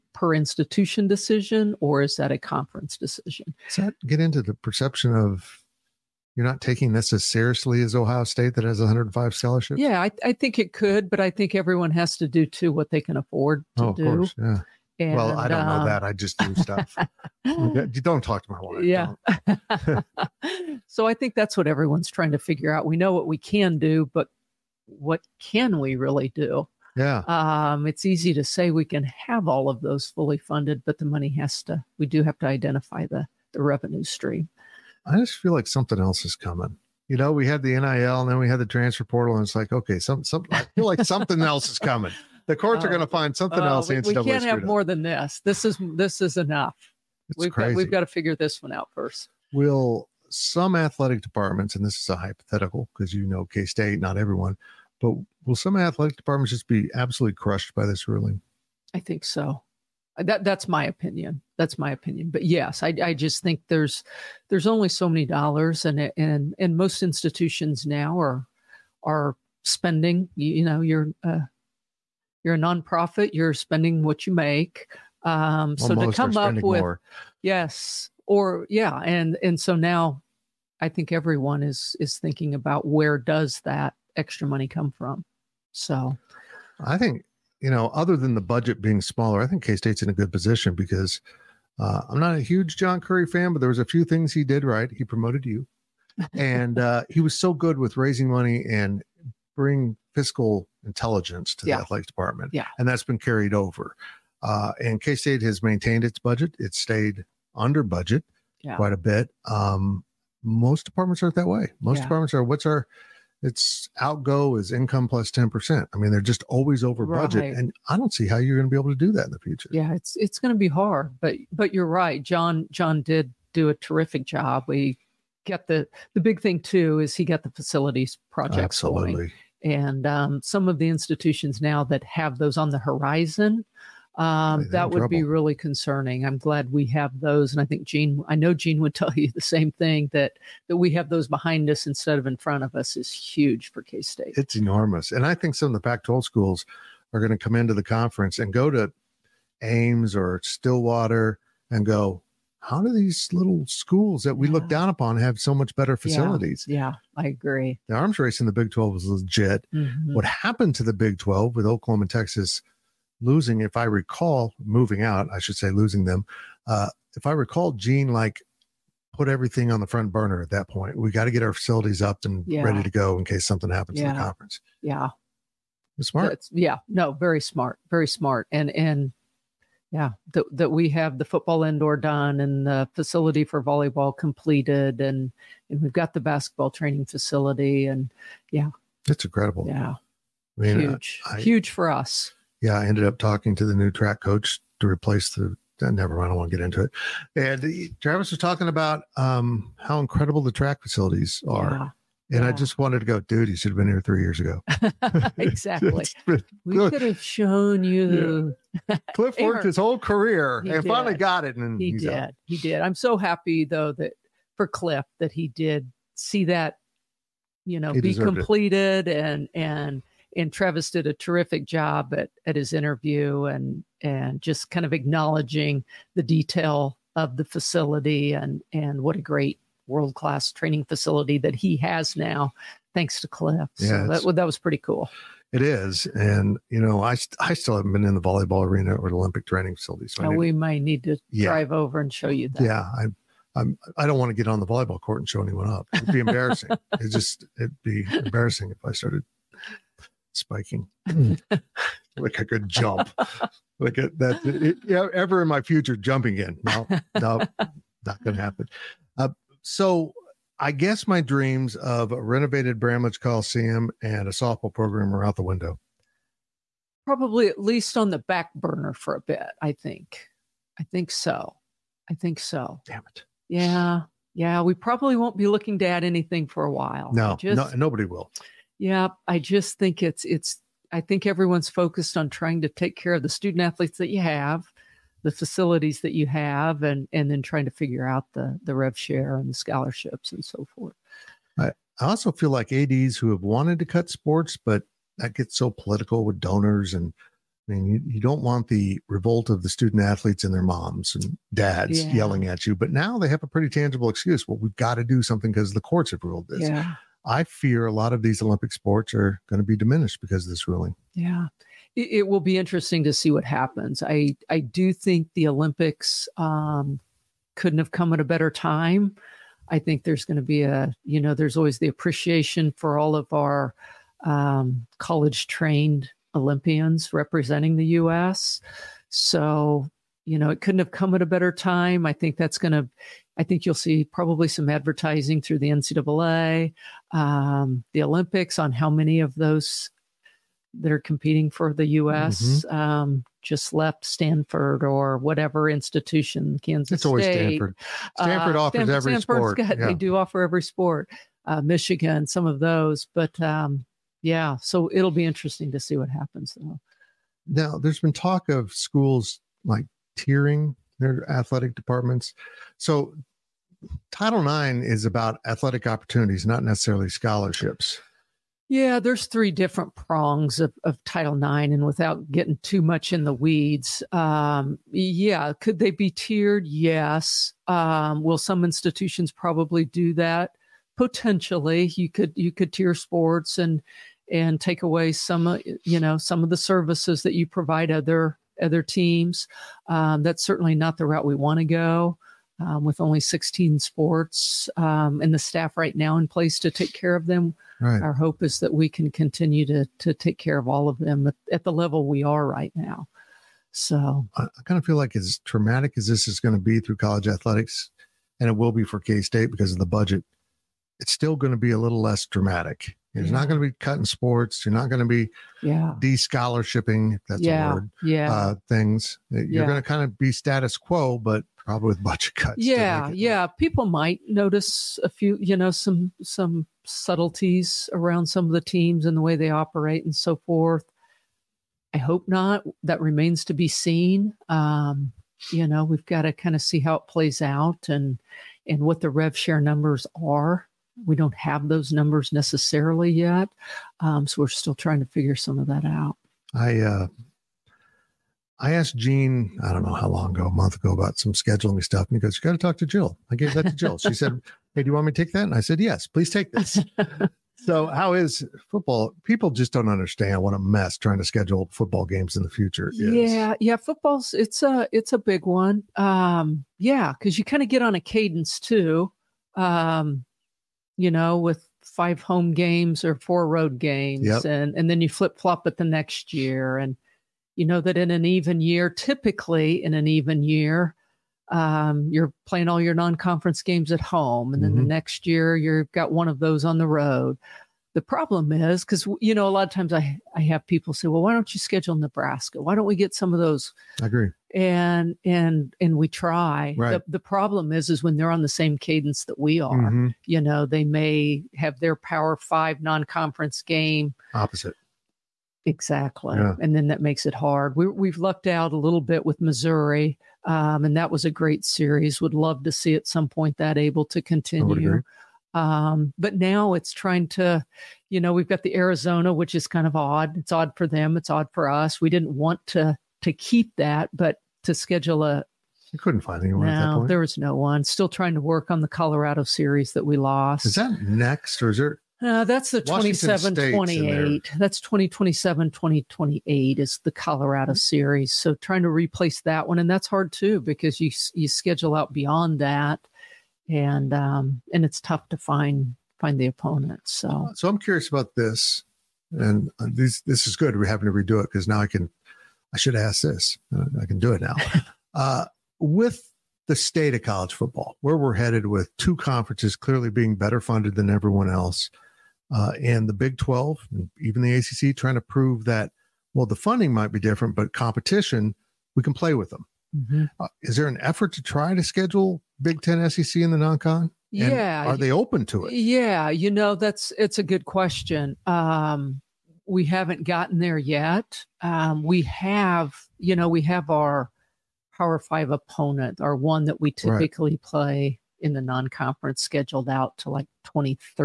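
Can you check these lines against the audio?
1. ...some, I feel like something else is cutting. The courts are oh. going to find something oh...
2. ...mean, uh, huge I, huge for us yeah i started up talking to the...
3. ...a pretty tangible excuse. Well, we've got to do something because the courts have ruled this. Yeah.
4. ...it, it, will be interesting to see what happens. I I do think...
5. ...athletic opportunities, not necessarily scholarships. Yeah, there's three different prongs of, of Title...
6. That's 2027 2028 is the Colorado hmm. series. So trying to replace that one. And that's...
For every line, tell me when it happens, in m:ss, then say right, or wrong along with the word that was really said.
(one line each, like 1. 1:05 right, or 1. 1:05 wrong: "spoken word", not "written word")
1. 0:40 wrong: "coming", not "cutting"
2. 3:10 wrong: "ended", not "started"
3. 5:03 right
4. 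5:11 right
5. 6:05 right
6. 8:54 right.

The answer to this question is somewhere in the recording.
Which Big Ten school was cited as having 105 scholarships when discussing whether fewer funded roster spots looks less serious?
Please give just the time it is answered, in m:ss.
0:07.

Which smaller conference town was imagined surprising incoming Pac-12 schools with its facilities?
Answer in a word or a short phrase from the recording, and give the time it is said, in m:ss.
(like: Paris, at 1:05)
Ames, at 2:29.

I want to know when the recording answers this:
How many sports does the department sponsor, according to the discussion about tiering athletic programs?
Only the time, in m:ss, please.
6:33.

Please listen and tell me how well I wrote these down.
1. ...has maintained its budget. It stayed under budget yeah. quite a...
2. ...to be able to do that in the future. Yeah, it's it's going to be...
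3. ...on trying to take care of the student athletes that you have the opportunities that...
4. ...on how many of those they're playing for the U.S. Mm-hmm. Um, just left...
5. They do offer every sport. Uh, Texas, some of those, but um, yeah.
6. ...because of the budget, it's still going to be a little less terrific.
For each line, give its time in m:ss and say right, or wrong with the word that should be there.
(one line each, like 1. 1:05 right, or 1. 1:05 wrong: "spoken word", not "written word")
1. 1:45 right
2. 1:58 right
3. 4:42 wrong: "facilities", not "opportunities"
4. 5:38 wrong: "competing", not "playing"
5. 5:49 wrong: "Michigan", not "Texas"
6. 6:49 wrong: "dramatic", not "terrific".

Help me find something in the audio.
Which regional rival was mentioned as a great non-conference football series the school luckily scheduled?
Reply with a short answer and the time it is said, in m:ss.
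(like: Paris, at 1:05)
Missouri, at 8:29.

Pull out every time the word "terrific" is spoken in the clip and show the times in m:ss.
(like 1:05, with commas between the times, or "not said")
2:03, 3:41.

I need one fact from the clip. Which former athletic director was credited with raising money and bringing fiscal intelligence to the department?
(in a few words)
John Currie.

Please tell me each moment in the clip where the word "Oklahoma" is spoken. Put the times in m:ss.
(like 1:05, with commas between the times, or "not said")
2:41.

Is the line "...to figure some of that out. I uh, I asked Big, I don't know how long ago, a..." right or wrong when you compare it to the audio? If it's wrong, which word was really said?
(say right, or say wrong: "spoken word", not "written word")
wrong: "Gene", not "Big".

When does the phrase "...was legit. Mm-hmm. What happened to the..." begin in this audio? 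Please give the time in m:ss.
2:38.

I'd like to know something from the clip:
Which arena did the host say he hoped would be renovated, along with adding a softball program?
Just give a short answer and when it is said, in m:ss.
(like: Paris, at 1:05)
Bramlage Coliseum, at 4:22.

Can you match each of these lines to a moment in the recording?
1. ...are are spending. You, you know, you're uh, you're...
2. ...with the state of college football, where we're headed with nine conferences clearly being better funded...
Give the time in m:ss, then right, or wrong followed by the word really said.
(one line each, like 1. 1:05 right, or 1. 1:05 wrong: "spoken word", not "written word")
1. 1:08 right
2. 9:15 wrong: "two", not "nine".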